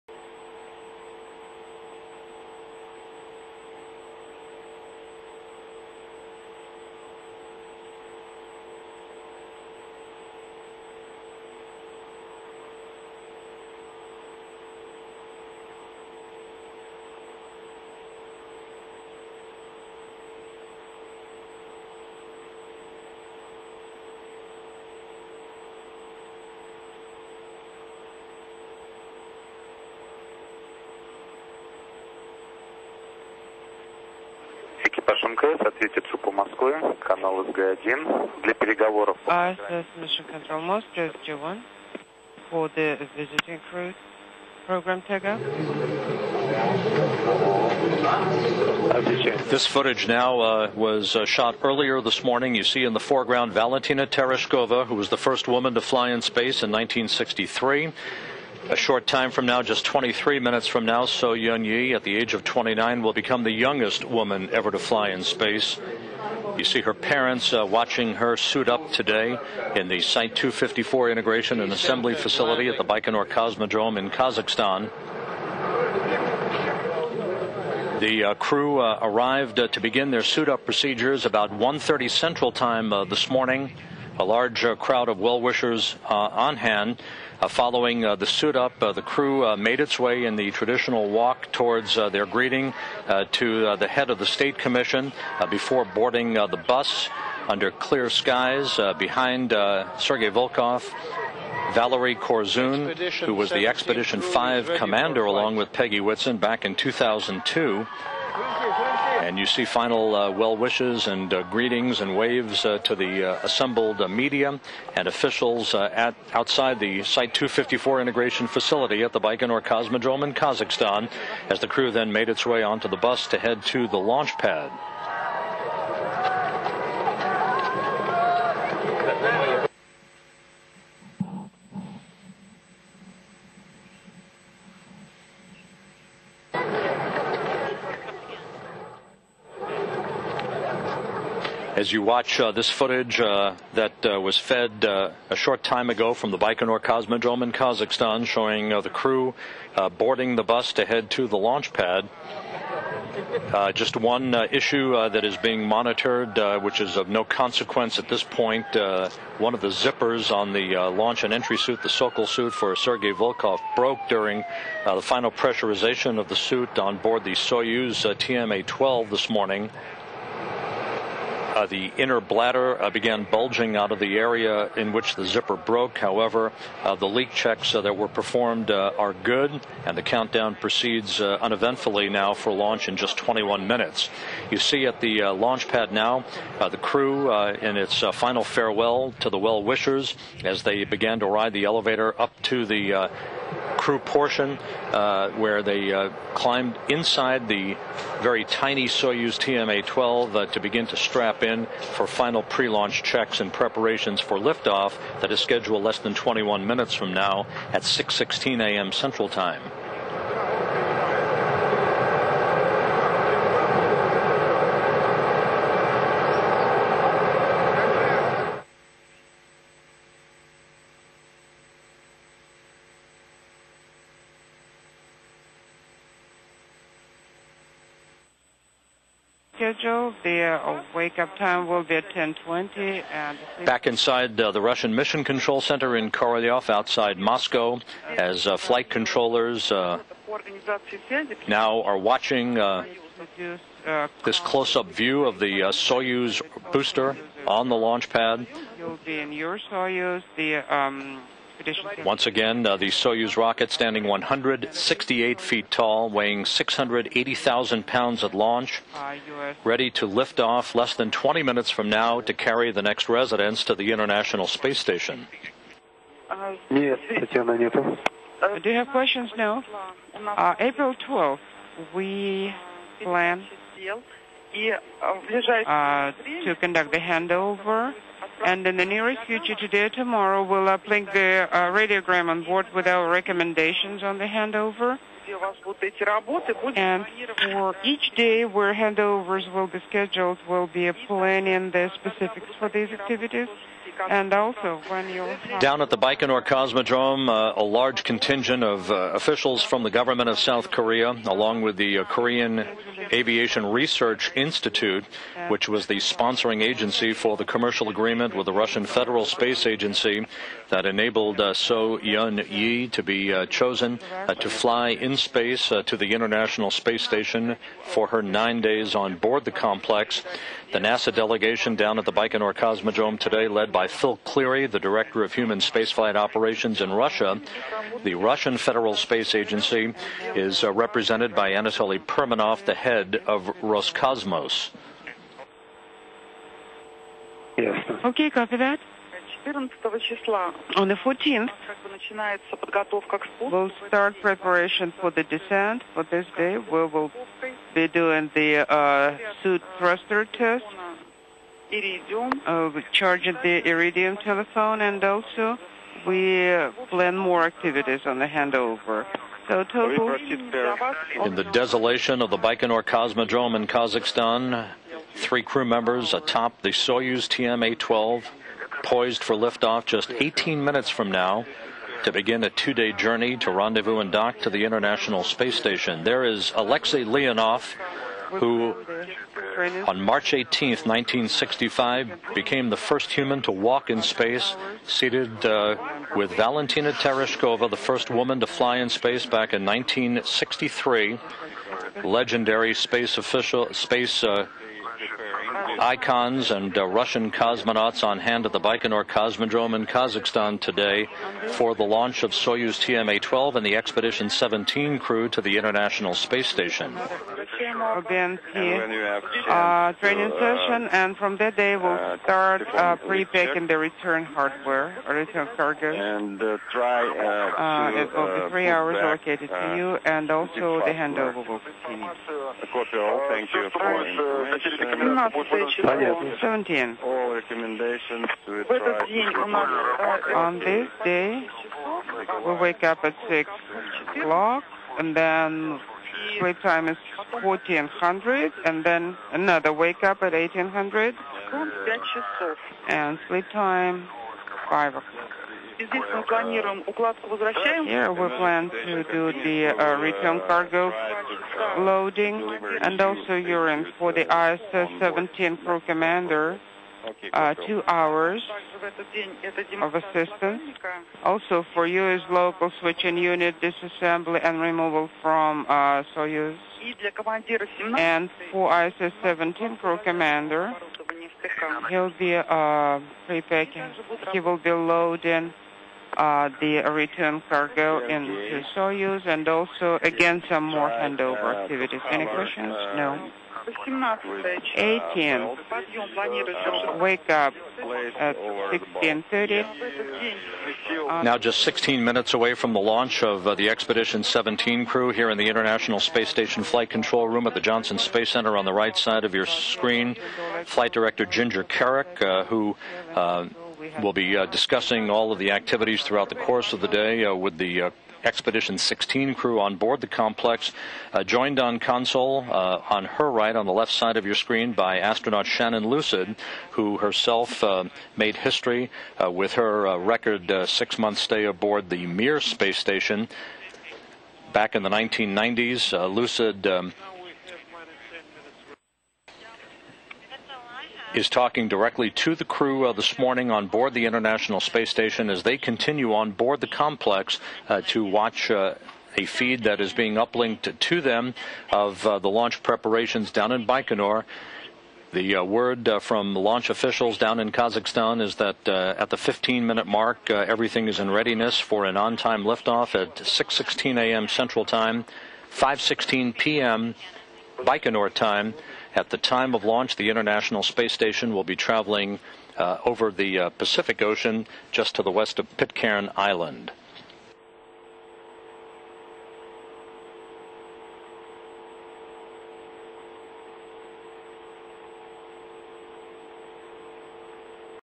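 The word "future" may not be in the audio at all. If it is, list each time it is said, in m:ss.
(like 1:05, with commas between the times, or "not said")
4:39.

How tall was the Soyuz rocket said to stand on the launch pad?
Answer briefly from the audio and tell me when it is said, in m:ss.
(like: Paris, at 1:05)
168 feet, at 4:14.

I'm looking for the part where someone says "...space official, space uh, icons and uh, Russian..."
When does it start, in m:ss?
6:32.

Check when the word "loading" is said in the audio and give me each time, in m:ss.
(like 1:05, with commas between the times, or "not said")
7:31, 7:54.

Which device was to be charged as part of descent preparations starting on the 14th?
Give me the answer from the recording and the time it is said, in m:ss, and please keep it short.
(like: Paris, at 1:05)
Iridium telephone, at 5:53.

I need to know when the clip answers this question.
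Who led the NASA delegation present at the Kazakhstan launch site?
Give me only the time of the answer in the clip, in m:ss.
5:23.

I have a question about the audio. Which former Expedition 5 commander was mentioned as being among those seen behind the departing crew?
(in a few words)
Valerie Korzun.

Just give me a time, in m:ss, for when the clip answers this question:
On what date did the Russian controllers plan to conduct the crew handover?
4:30.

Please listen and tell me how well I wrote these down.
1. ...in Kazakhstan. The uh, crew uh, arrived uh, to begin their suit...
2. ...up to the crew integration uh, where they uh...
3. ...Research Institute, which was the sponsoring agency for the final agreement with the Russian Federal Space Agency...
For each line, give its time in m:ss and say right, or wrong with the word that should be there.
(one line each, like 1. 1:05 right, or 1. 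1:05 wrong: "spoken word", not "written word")
1. 1:13 right
2. 3:12 wrong: "portion", not "integration"
3. 5:03 wrong: "commercial", not "final".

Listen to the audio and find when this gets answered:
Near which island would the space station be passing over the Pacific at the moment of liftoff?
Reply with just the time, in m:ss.
9:25.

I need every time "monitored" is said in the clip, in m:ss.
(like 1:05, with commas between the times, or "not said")
2:35.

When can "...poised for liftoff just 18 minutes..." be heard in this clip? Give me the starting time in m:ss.
6:08.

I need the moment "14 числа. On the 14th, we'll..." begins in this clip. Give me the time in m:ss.
5:39.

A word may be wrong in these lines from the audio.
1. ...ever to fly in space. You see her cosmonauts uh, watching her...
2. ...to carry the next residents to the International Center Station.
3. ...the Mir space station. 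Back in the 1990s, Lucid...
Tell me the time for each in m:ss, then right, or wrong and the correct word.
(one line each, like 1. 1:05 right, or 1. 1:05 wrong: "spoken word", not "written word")
1. 1:04 wrong: "parents", not "cosmonauts"
2. 4:22 wrong: "Space", not "Center"
3. 8:41 right.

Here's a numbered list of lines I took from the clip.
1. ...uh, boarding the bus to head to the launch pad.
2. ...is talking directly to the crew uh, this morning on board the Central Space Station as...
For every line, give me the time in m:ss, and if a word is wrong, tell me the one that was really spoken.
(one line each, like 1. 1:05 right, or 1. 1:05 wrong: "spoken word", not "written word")
1. 2:29 right
2. 8:51 wrong: "International", not "Central".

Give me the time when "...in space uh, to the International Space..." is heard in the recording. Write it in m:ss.
5:14.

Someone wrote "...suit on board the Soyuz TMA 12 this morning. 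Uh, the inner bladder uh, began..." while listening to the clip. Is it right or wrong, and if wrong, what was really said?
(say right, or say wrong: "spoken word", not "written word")
right.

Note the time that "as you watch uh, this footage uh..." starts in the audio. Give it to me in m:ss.
2:21.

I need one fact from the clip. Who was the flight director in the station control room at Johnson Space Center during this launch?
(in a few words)
Ginger Kerrick.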